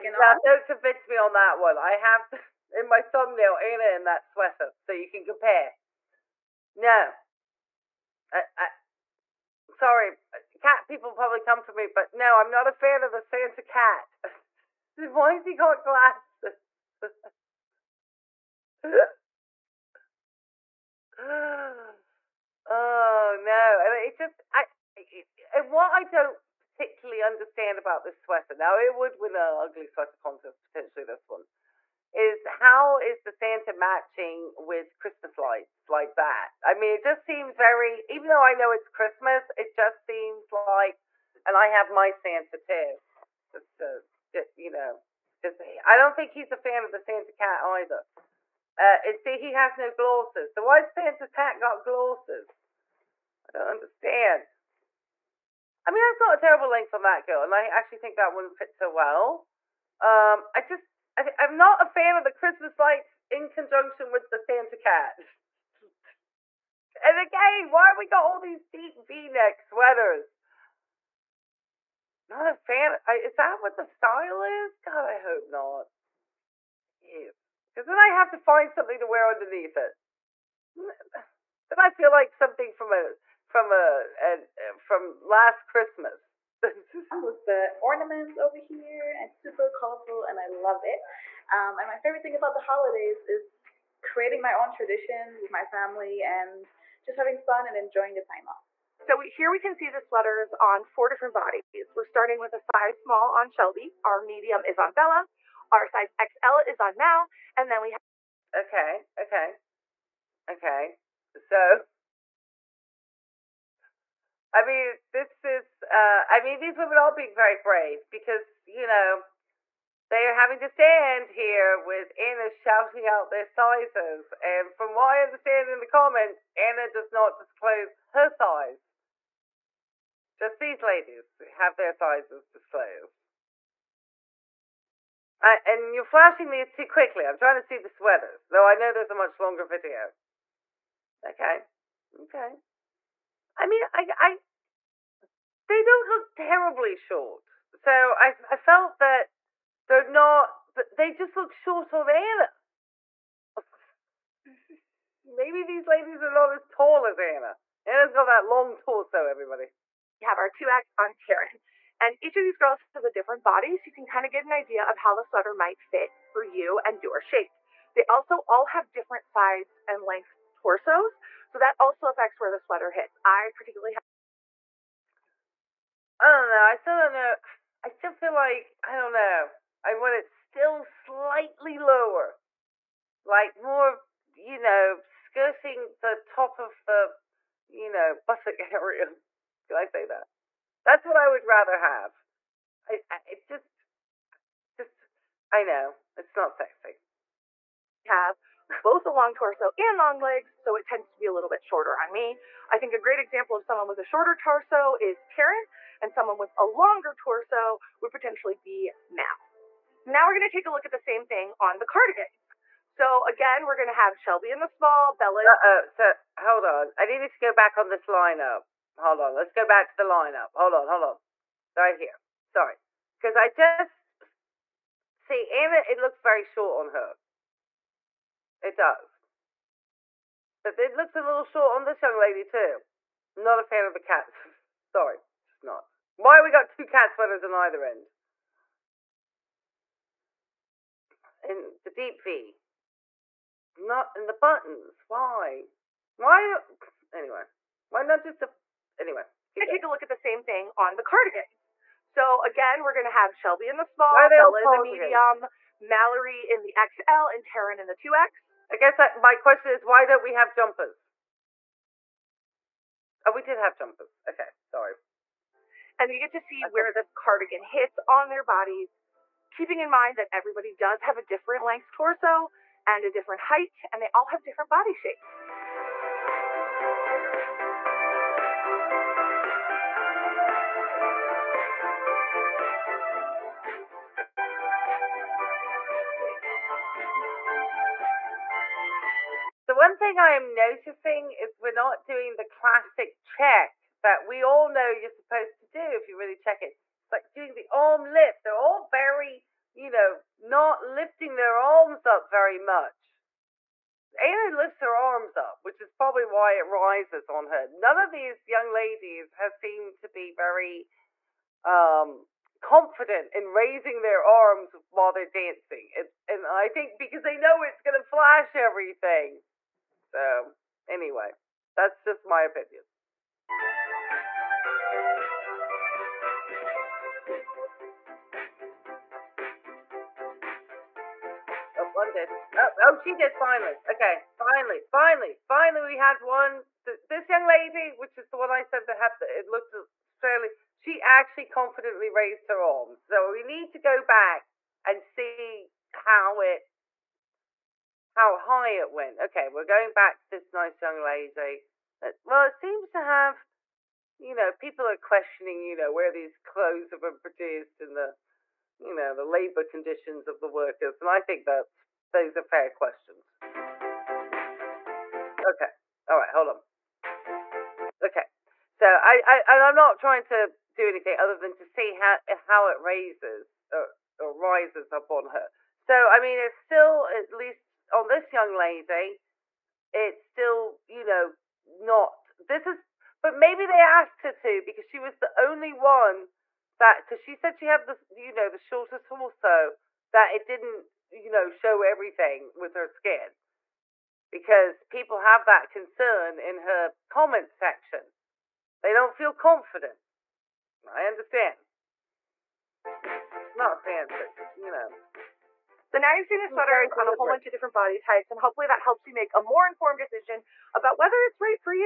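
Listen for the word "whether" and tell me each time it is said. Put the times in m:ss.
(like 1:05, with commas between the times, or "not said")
6:50.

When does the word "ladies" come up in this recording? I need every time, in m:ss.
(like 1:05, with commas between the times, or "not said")
2:10, 2:35, 5:08.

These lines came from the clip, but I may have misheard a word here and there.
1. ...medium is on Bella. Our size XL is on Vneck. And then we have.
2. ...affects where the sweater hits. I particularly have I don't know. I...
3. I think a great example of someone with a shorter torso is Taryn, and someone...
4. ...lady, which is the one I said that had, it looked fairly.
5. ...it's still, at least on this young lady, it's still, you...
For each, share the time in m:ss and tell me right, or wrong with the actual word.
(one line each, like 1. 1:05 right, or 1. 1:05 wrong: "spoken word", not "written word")
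1. 1:44 wrong: "Mal", not "Vneck"
2. 2:52 right
3. 3:22 right
4. 5:37 right
5. 6:16 right.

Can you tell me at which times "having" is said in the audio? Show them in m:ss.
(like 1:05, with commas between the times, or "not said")
1:37, 2:00.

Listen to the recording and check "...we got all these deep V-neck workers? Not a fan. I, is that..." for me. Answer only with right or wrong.
wrong.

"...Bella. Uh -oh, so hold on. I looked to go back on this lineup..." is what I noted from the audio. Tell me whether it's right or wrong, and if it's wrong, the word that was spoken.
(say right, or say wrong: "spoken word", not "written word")
wrong: "needed", not "looked".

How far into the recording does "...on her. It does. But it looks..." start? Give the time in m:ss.
3:46.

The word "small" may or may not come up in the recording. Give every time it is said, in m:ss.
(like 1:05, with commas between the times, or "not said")
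1:43, 3:34, 4:13.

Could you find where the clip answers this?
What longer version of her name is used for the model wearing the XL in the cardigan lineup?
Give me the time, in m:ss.
4:15.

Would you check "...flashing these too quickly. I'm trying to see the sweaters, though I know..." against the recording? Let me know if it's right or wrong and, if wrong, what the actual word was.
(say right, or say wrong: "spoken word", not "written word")
right.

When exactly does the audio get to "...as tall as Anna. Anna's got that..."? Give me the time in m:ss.
2:36.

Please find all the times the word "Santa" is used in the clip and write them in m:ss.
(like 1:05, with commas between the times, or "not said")
0:13, 0:33, 0:42, 0:46, 0:50, 1:04.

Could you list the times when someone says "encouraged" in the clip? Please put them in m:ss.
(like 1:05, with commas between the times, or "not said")
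not said.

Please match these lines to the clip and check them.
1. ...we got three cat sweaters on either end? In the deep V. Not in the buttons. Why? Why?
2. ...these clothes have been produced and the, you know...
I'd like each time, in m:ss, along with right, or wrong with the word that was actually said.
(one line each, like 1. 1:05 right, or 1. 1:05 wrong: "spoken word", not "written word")
1. 3:56 wrong: "two", not "three"
2. 5:56 right.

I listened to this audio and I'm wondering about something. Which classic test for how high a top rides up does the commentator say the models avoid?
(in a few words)
arm lift.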